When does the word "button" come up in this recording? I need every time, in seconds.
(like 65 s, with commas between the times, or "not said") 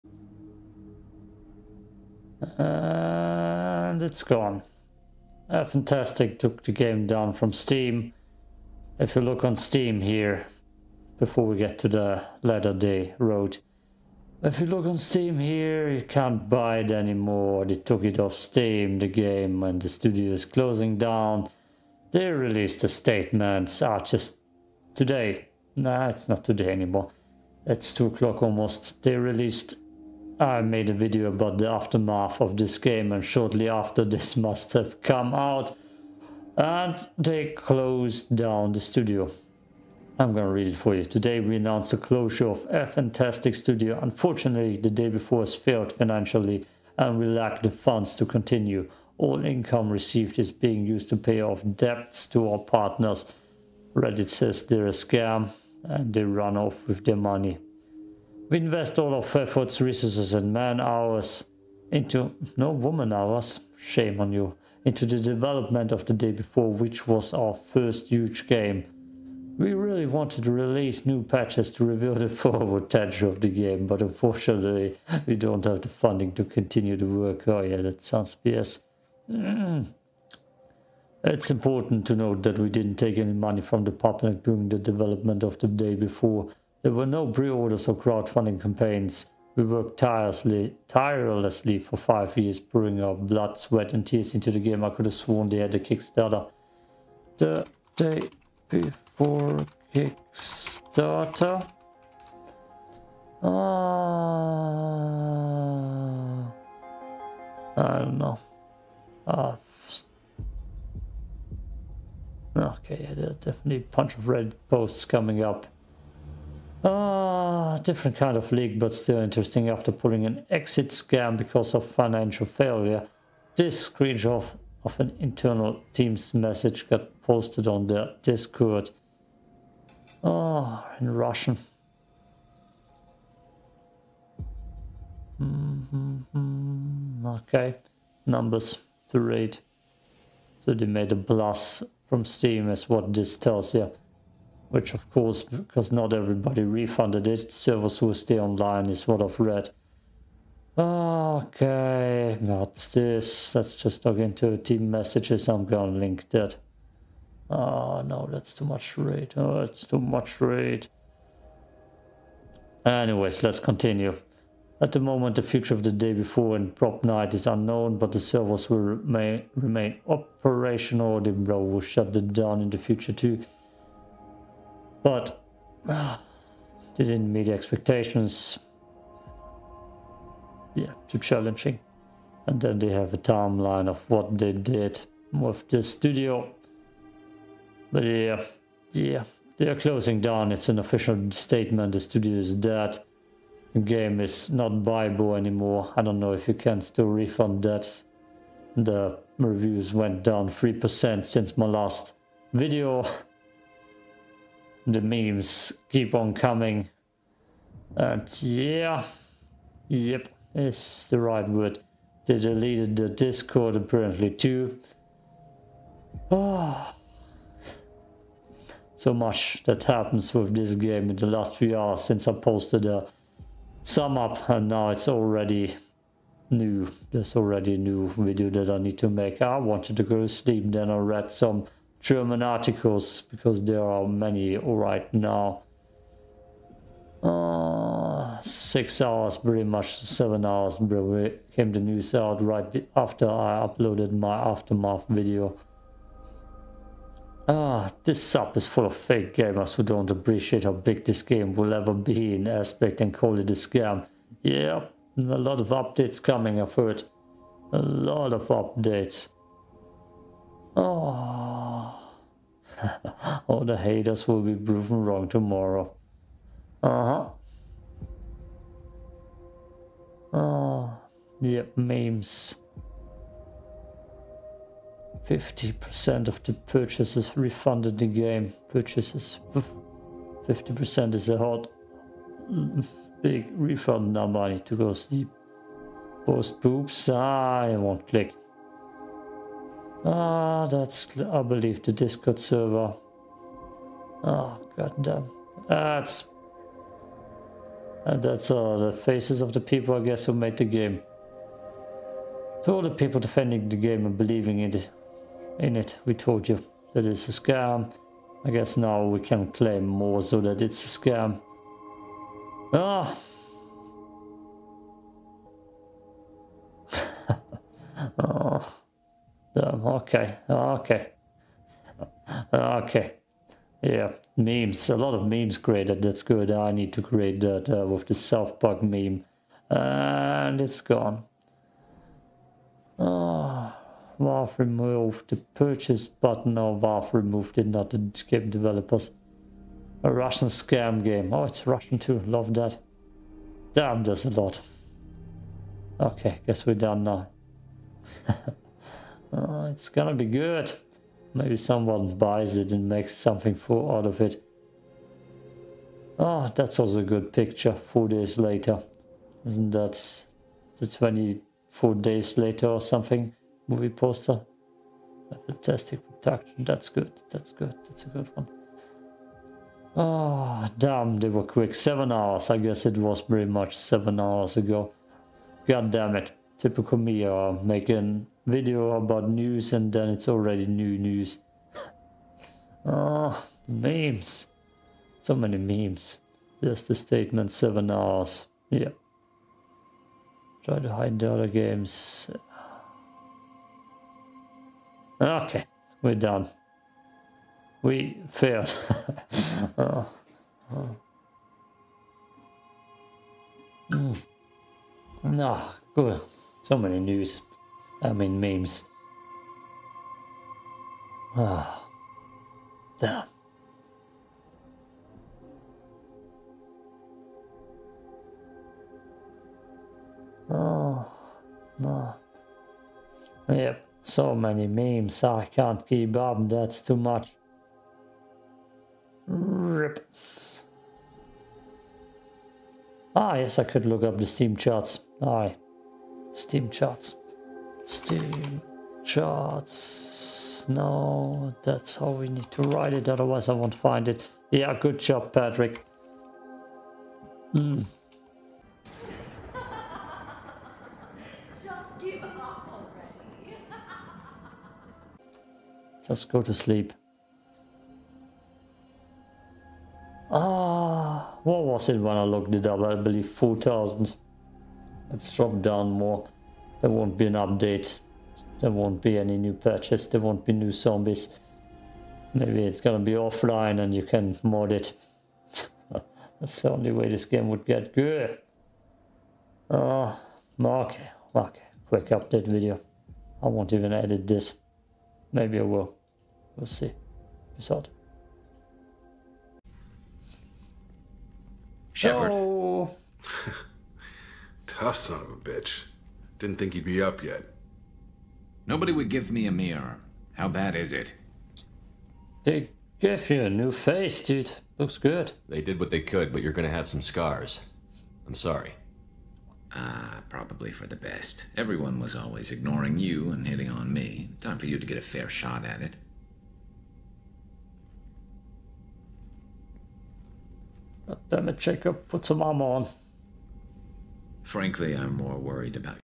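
336 s.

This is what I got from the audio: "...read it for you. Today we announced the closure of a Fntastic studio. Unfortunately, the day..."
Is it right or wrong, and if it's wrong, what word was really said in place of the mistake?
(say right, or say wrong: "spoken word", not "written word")
right.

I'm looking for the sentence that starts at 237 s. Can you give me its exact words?
Uh, six hours, pretty much seven hours, came the news out right after I uploaded my aftermath video.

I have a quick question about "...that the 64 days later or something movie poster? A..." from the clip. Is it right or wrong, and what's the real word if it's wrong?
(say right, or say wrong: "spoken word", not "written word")
wrong: "24", not "64".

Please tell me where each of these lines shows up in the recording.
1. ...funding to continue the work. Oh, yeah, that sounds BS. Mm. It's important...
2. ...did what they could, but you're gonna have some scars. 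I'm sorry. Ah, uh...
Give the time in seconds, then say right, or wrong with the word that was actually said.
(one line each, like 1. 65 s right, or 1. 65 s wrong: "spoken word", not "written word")
1. 75 s right
2. 505 s right.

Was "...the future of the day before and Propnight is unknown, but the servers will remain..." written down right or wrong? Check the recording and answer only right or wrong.
right.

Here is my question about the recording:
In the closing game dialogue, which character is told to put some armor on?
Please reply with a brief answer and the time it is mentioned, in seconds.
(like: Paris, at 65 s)
Jacob, at 521 s.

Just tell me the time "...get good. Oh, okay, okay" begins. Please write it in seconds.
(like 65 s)
477 s.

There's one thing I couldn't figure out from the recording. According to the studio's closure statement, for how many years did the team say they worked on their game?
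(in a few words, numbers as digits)
5 years.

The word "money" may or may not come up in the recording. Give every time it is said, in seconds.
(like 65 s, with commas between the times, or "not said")
57 s, 83 s.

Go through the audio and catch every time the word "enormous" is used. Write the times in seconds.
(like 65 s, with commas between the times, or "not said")
not said.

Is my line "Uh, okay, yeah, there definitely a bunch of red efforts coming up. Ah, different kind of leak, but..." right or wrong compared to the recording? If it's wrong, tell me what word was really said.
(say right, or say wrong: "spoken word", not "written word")
wrong: "posts", not "efforts".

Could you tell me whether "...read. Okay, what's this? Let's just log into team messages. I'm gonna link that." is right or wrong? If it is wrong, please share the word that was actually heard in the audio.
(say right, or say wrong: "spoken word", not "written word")
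right.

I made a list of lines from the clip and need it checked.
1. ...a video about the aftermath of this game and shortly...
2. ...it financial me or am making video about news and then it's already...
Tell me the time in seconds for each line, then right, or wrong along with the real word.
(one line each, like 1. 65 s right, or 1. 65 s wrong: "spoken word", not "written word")
1. 30 s right
2. 376 s wrong: "typical", not "financial".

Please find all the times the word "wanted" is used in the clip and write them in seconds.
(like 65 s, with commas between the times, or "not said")
70 s, 229 s.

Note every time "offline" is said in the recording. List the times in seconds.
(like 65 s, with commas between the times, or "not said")
473 s.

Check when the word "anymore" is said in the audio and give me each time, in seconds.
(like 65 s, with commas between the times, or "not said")
16 s, 26 s, 195 s.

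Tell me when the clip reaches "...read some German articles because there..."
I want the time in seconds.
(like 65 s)
230 s.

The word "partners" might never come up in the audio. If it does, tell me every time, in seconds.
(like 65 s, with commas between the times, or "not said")
52 s.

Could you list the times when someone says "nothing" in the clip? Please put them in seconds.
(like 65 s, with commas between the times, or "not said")
not said.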